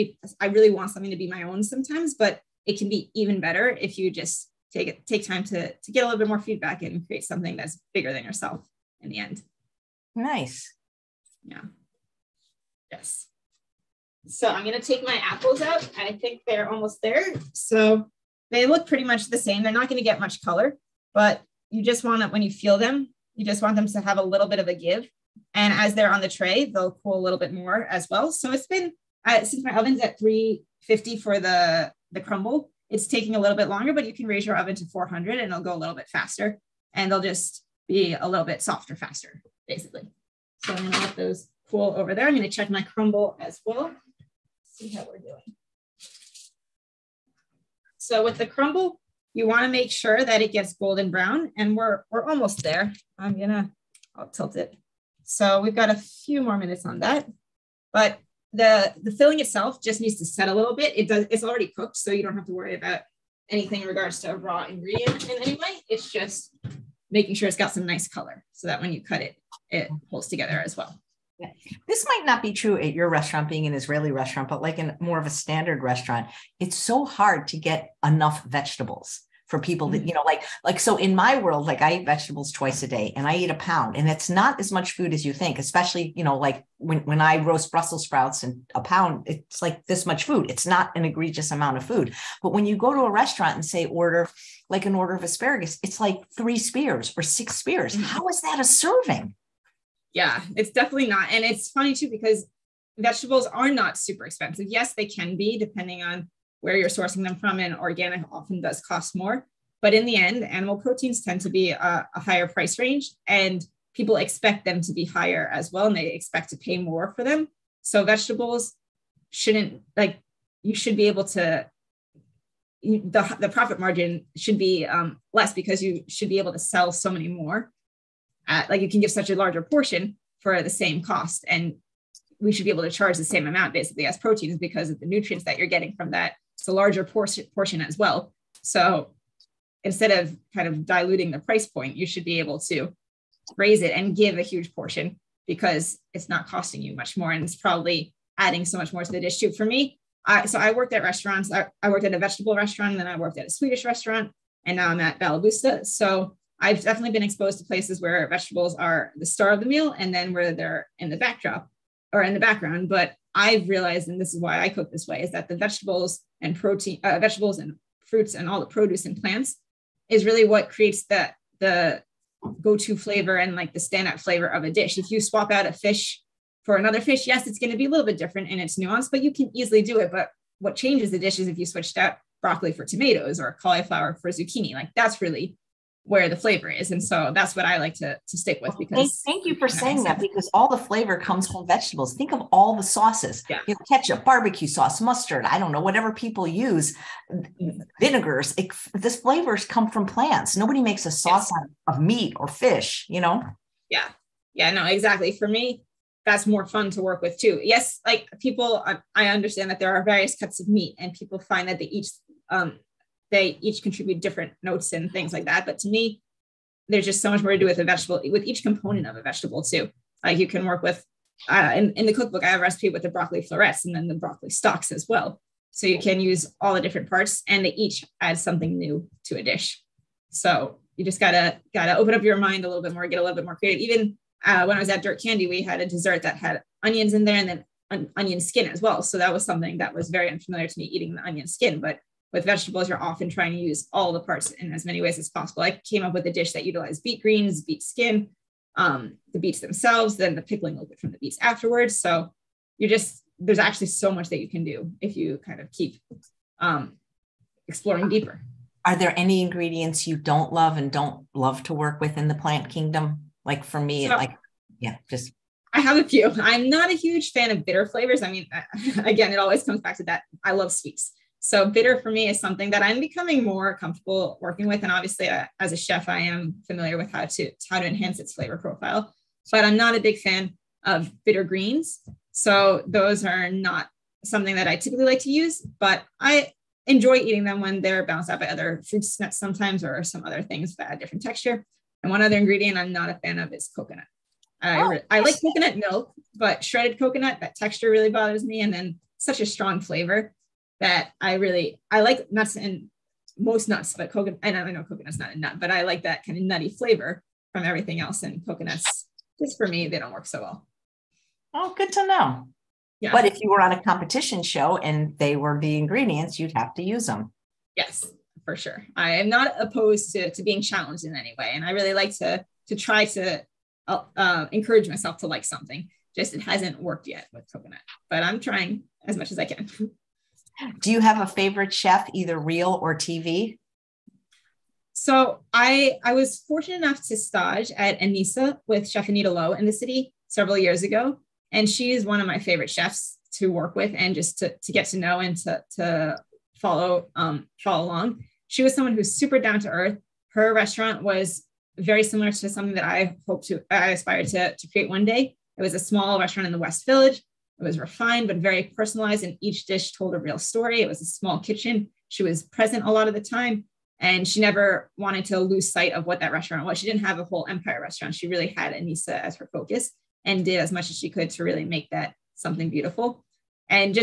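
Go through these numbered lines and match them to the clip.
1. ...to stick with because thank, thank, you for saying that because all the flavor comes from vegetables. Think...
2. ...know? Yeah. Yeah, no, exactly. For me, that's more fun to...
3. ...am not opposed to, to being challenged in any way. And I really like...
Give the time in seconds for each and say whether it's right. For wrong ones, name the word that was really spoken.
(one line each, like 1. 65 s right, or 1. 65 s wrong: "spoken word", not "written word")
1. 188 s right
2. 203 s right
3. 319 s right.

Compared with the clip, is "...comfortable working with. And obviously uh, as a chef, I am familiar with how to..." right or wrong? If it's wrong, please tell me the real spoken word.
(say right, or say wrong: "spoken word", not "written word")
right.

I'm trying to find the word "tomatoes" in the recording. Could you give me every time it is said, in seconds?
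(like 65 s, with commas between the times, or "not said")
182 s.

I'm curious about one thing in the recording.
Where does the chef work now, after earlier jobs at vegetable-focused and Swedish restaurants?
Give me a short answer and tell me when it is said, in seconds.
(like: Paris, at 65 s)
Balaboosta, at 155 s.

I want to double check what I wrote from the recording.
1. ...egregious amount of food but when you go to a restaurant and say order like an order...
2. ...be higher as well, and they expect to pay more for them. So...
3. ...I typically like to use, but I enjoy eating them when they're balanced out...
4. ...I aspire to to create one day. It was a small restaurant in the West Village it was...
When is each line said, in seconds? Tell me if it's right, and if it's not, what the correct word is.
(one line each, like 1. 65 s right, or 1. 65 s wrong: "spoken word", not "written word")
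1. 91 s right
2. 114 s right
3. 284 s right
4. 353 s right.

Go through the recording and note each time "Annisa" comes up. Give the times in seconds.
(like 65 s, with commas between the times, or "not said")
338 s, 368 s.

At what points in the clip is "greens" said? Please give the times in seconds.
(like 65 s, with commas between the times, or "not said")
247 s, 281 s.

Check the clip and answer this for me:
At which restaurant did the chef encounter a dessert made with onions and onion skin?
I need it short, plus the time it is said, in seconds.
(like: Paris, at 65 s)
Dirt Candy, at 235 s.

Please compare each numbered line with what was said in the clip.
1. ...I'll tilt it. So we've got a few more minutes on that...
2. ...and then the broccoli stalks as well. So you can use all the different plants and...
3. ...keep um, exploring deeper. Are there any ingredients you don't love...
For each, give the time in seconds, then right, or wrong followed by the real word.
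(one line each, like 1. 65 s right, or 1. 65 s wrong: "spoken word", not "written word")
1. 54 s right
2. 223 s wrong: "parts", not "plants"
3. 255 s right.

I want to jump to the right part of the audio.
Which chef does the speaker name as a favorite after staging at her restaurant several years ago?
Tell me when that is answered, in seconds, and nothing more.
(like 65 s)
339 s.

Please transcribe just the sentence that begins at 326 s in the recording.
Just it hasn't worked yet with coconut, but I'm trying as much as I can.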